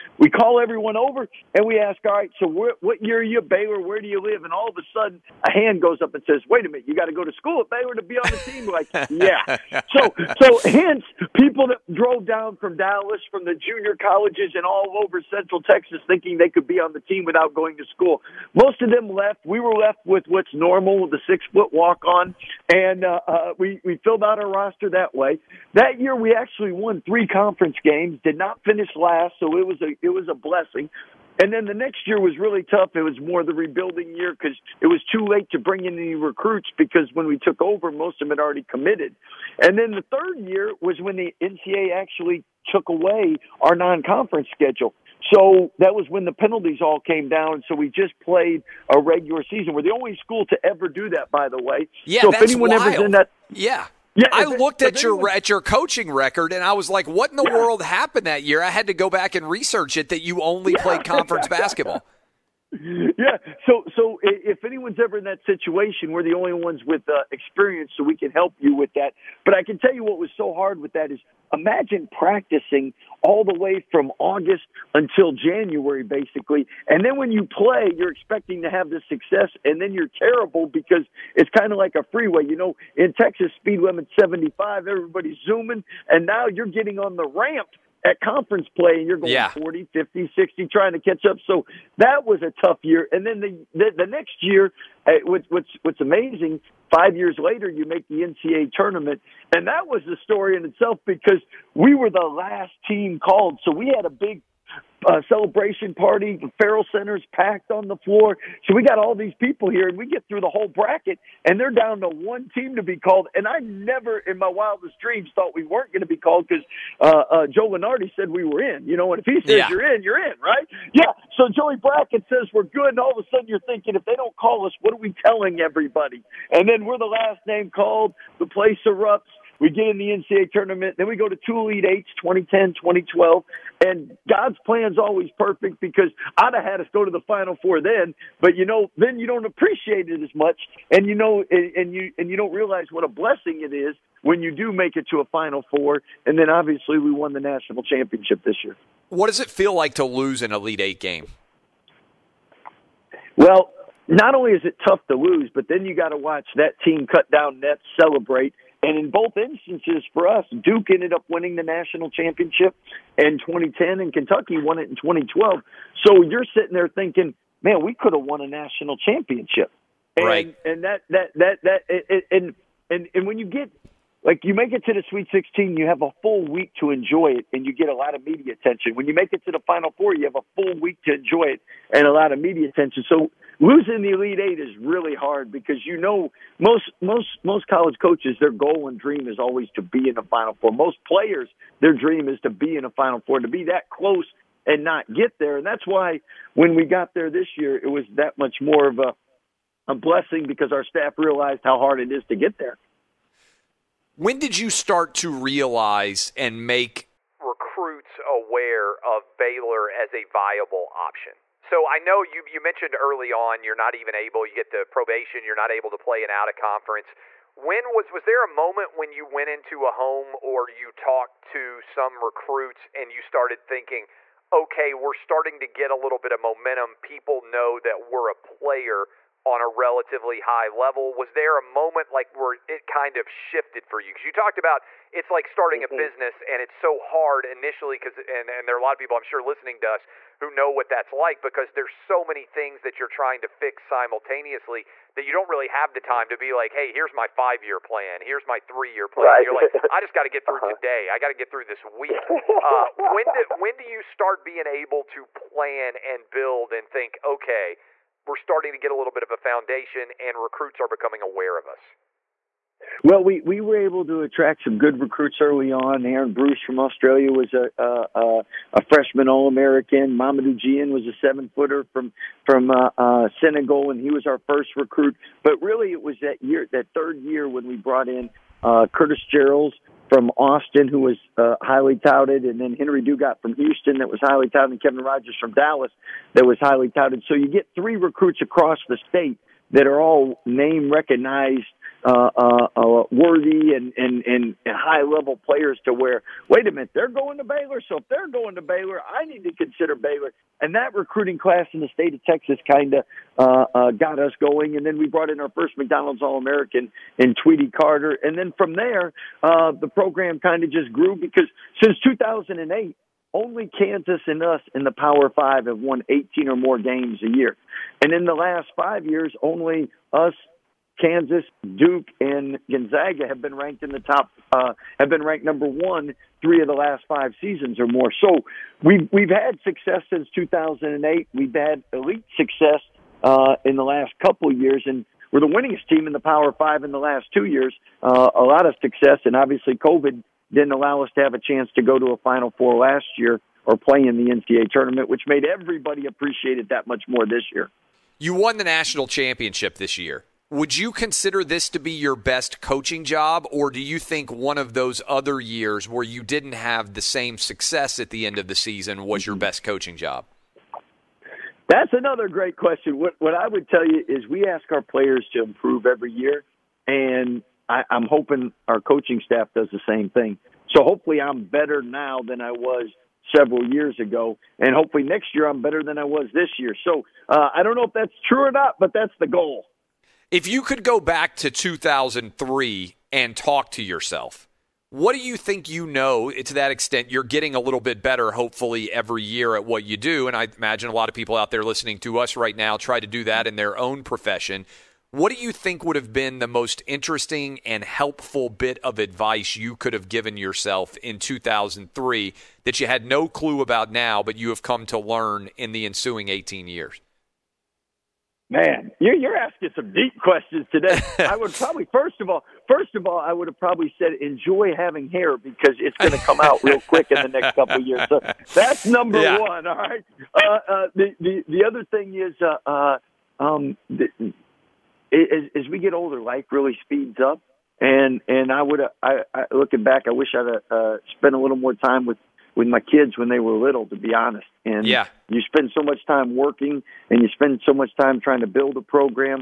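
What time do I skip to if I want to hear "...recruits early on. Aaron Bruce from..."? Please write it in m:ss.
4:25.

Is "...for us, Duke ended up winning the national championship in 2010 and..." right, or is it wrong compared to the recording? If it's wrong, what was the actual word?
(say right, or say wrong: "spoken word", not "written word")
right.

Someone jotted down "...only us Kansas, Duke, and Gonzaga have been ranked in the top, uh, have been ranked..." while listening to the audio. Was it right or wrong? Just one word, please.
right.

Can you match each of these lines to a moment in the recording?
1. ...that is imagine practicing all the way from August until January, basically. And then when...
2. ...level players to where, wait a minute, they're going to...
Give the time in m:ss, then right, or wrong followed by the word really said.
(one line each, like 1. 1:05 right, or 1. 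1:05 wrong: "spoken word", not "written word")
1. 1:10 right
2. 4:55 right.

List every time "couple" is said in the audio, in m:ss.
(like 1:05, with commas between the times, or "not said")
5:34, 6:57.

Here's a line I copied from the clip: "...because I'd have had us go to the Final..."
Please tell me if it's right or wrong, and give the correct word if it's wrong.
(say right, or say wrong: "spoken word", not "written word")
right.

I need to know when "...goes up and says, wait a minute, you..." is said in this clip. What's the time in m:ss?
0:05.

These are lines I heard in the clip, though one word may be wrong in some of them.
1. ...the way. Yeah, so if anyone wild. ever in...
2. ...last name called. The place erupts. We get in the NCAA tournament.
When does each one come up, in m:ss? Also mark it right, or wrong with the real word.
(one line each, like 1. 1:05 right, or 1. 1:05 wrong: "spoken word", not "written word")
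1. 0:51 right
2. 2:07 right.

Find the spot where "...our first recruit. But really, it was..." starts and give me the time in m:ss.
4:34.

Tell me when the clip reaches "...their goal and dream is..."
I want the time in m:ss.
3:08.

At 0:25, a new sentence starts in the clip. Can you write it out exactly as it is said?
That year we actually won three conference games, did not finish last, so it was a it was a blessing.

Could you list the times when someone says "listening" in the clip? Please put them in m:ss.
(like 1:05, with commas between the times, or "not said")
3:59, 6:31.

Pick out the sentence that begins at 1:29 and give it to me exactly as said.
40, 50, 60 trying to catch up.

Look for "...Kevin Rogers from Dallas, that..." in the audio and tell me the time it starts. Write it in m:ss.
4:44.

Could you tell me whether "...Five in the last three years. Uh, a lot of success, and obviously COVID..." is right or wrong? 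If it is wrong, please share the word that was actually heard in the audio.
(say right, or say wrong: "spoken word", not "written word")
wrong: "two", not "three".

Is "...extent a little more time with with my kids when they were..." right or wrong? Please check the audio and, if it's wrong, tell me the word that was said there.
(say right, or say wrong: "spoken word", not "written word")
wrong: "spent", not "extent".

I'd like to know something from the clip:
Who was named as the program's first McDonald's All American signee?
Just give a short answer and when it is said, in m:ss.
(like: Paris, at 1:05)
Tweety Carter, at 5:07.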